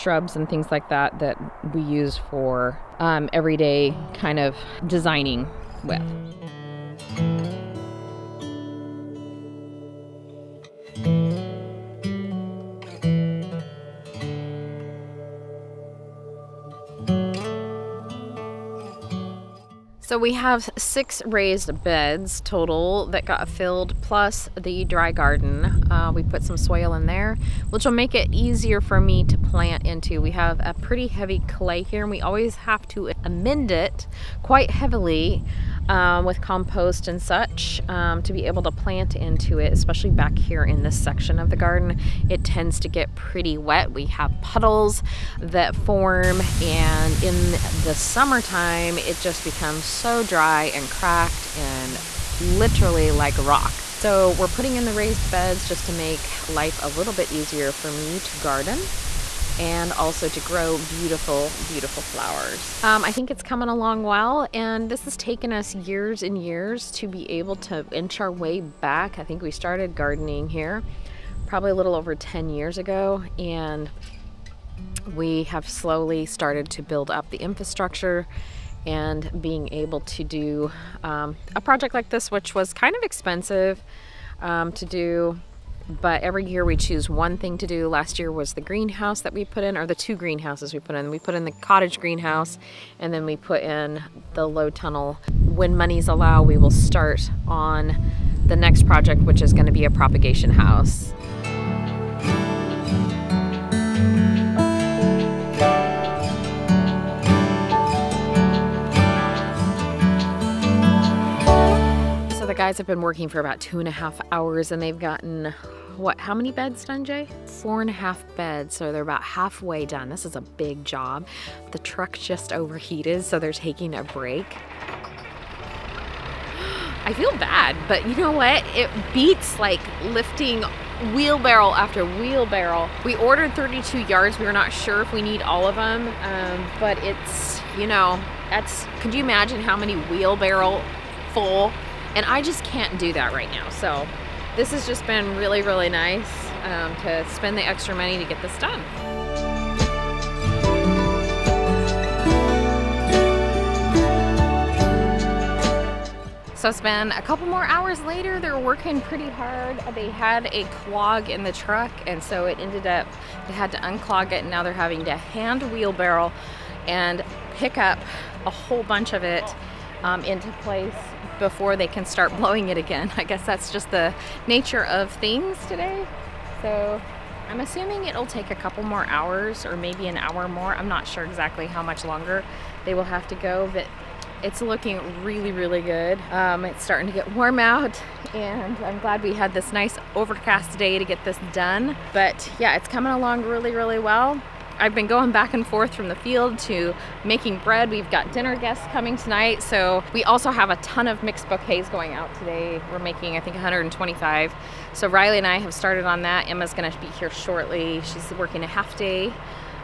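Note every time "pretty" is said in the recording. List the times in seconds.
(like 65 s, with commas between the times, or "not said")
30 s, 43 s, 159 s.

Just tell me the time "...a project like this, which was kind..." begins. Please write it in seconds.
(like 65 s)
81 s.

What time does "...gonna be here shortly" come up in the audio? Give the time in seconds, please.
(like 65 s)
206 s.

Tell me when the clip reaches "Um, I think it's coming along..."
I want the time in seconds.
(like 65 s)
62 s.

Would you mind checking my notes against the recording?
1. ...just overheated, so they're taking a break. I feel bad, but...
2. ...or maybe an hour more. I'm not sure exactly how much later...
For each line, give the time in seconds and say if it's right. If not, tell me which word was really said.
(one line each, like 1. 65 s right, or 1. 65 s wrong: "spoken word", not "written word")
1. 122 s right
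2. 179 s wrong: "longer", not "later".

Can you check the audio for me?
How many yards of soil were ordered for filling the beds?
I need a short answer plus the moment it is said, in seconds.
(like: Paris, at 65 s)
32, at 133 s.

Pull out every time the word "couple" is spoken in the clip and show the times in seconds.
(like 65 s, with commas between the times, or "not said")
157 s, 178 s.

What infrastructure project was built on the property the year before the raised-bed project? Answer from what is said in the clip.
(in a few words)
the greenhouse.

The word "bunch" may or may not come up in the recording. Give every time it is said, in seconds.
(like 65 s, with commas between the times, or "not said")
168 s.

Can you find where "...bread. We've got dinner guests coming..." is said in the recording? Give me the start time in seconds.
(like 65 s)
197 s.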